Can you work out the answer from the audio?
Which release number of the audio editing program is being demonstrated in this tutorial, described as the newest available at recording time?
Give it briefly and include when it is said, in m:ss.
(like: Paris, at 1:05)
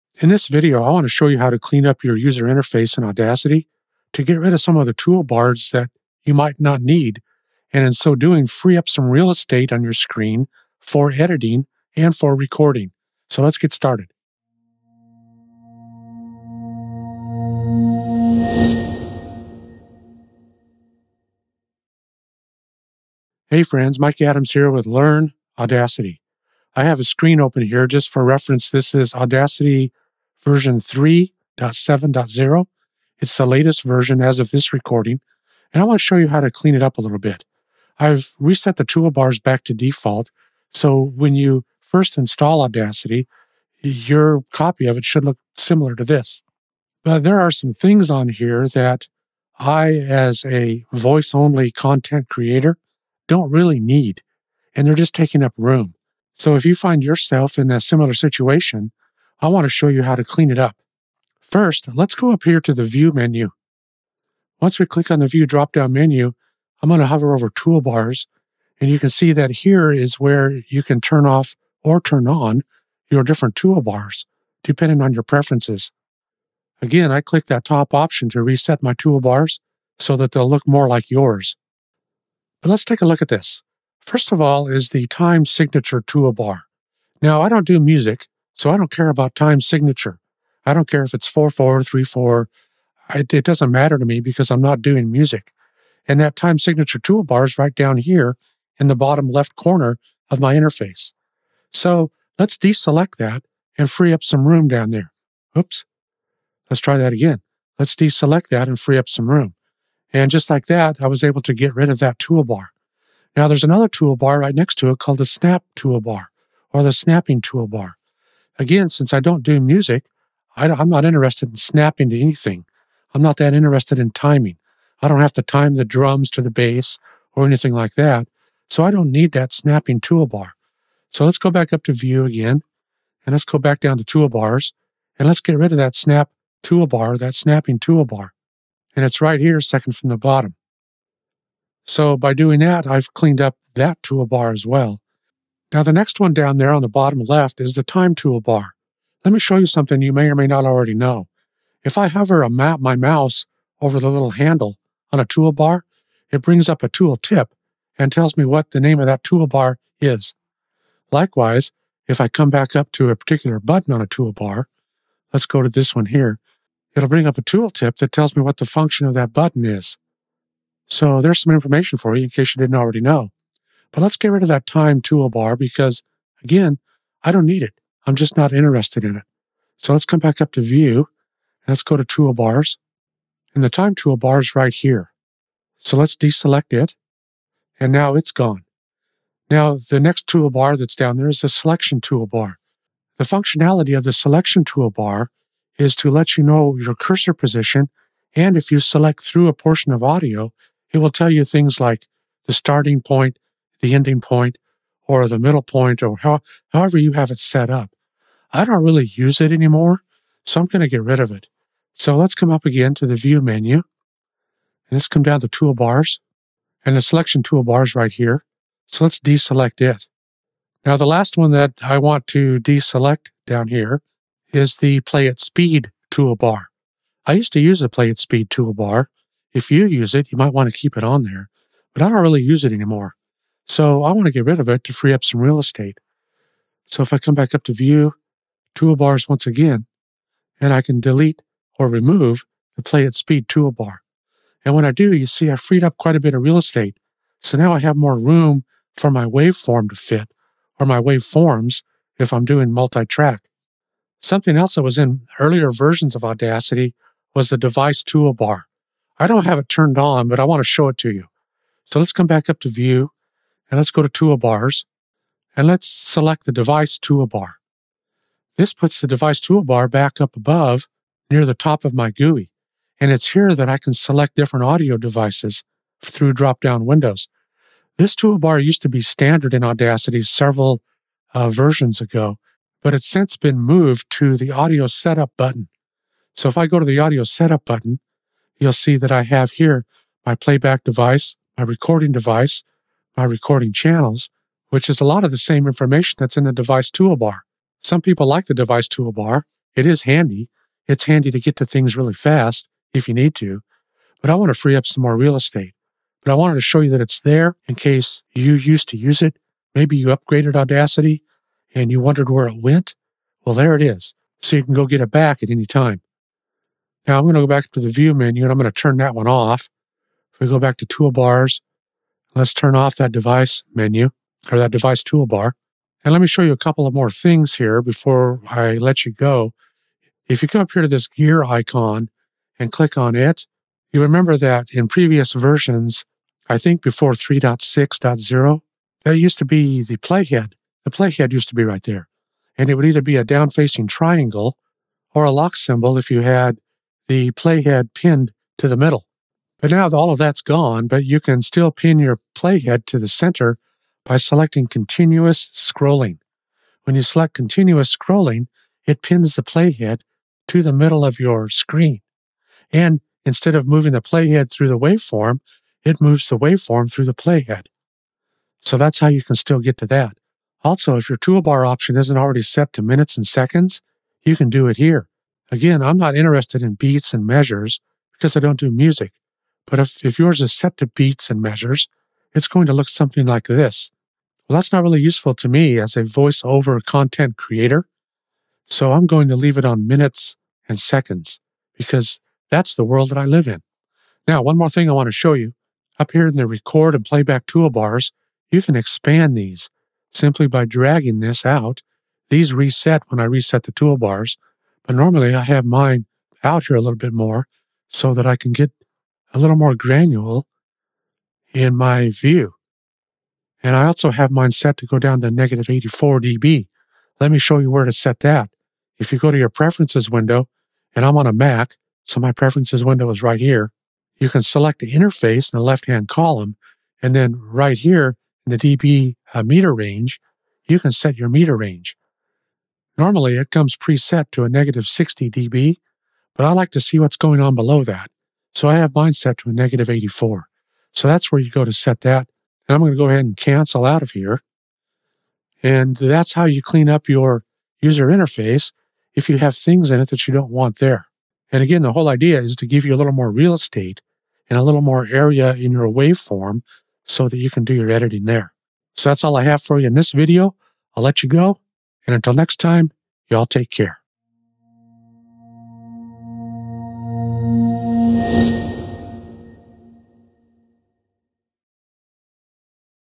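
3.7.0, at 0:30.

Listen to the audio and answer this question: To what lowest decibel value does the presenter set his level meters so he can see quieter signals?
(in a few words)
-84 dB.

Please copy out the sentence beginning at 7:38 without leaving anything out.
So that's all I have for you in this video.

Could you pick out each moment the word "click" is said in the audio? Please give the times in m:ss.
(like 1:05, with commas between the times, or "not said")
1:04, 1:17, 5:32.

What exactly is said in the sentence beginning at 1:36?
And that time signature toolbar is right down here in the bottom left corner of my interface.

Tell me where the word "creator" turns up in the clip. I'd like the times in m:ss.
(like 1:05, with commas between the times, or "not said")
0:52, 6:27.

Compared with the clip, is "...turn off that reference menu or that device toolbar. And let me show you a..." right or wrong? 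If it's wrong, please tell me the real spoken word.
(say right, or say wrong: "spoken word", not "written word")
wrong: "device", not "reference".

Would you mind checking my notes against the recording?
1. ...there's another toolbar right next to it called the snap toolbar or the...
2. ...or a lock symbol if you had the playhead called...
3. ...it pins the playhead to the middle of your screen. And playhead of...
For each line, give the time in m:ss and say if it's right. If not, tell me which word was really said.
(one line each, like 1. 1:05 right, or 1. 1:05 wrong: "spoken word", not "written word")
1. 1:53 right
2. 5:45 wrong: "pinned", not "called"
3. 5:58 wrong: "instead", not "playhead".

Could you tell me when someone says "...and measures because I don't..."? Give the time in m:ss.
6:17.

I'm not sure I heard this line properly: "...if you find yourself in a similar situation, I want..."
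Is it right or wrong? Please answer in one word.
right.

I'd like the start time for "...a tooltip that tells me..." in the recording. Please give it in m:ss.
2:47.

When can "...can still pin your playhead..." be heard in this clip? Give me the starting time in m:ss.
5:51.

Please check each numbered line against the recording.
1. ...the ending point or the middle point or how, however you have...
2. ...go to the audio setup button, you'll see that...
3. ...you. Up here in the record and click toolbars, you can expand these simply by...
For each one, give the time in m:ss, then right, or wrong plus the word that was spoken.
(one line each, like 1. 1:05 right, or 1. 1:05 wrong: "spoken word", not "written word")
1. 3:23 right
2. 4:46 right
3. 6:35 wrong: "playback", not "click".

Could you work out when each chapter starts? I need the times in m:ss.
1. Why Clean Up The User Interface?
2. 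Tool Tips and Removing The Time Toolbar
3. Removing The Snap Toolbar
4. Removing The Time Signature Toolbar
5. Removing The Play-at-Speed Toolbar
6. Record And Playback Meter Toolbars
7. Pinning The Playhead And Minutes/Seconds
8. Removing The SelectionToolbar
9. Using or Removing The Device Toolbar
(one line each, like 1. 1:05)
1. 0:23
2. 2:26
3. 1:53
4. 1:01
5. 3:40
6. 6:34
7. 5:26
8. 3:09
9. 4:14.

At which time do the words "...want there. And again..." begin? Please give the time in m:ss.
7:30.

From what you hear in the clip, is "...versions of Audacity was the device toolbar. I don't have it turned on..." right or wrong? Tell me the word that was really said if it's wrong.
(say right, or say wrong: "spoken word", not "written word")
right.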